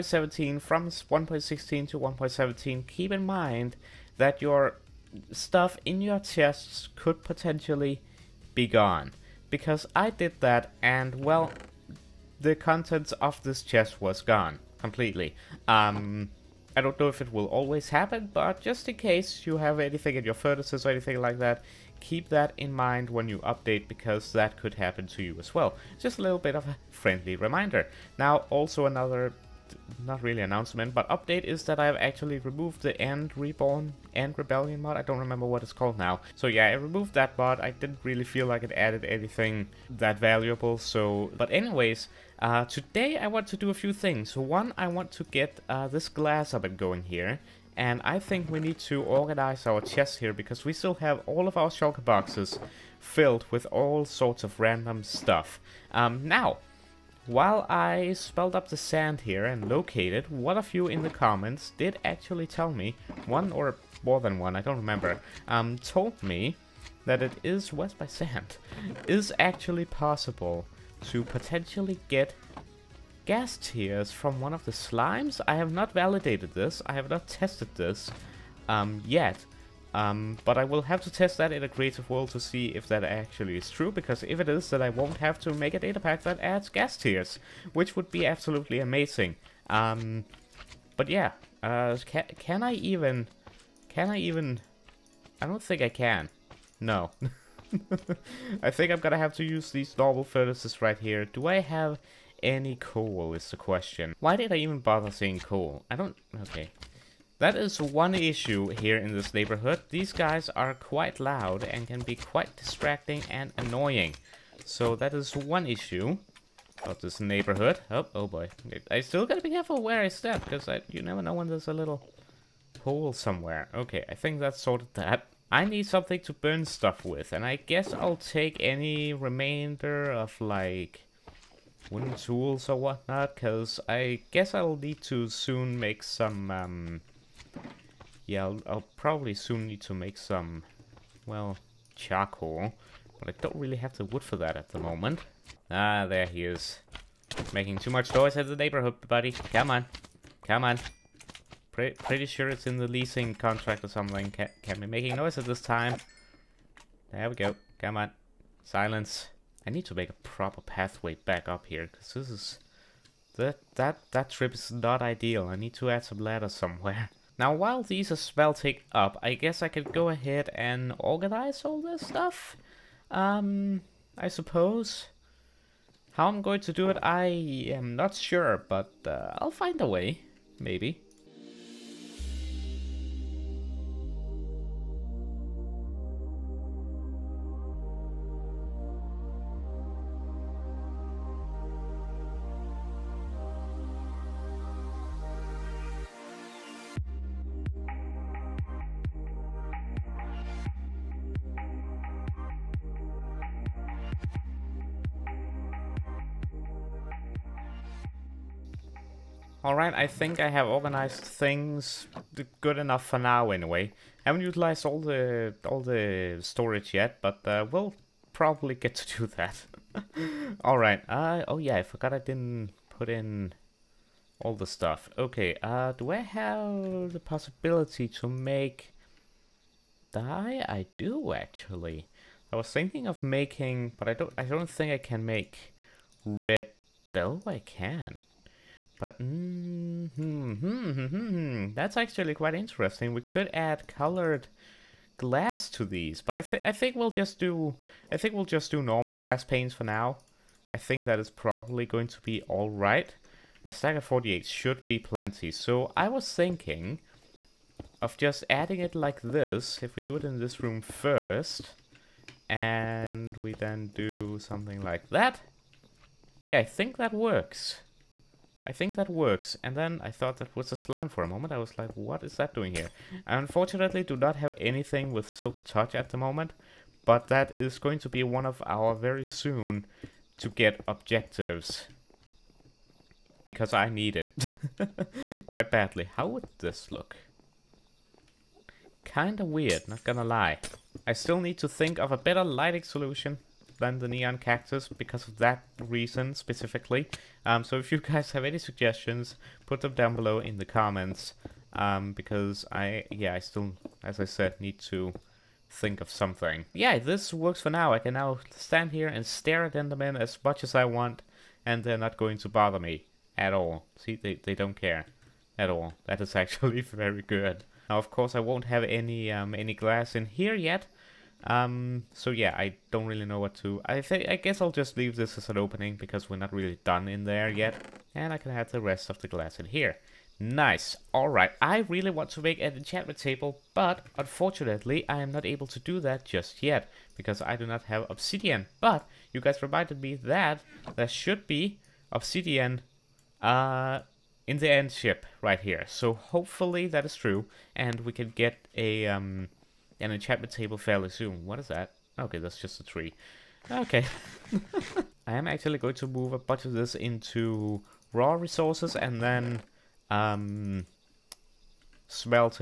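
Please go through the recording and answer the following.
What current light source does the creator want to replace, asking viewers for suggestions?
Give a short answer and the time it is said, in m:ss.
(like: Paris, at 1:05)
neon cactus, at 4:54.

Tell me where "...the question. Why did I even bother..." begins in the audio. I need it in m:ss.
1:43.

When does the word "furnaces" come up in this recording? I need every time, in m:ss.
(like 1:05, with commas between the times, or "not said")
0:20, 1:40.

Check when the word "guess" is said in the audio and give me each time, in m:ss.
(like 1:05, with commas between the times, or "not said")
2:07, 2:14, 2:49, 5:24.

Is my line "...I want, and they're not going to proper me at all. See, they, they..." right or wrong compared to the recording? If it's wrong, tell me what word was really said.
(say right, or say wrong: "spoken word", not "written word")
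wrong: "bother", not "proper".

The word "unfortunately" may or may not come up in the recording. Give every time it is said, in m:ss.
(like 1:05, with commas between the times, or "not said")
4:33, 5:34.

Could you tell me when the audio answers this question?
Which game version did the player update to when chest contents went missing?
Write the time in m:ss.
0:01.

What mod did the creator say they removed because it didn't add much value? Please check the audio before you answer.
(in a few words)
End Reborn.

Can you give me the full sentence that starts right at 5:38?
But you guys reminded me that there should be obsidian uh, in the end ship right here.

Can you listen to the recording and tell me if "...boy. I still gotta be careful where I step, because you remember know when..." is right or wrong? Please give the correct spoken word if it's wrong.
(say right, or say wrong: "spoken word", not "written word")
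wrong: "never", not "remember".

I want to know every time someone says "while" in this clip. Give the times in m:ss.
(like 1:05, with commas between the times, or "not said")
0:57, 2:47.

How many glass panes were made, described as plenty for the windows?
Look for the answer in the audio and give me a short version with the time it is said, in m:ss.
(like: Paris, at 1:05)
48, at 4:14.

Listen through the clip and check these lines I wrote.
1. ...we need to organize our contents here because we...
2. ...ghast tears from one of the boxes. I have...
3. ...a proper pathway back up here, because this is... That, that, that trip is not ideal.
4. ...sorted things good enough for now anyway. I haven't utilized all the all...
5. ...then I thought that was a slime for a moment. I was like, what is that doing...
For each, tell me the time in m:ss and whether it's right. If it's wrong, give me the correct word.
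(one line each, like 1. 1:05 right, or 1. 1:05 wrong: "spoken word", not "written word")
1. 0:48 wrong: "chests", not "contents"
2. 1:13 wrong: "slimes", not "boxes"
3. 2:40 right
4. 3:30 wrong: "organized", not "sorted"
5. 4:29 right.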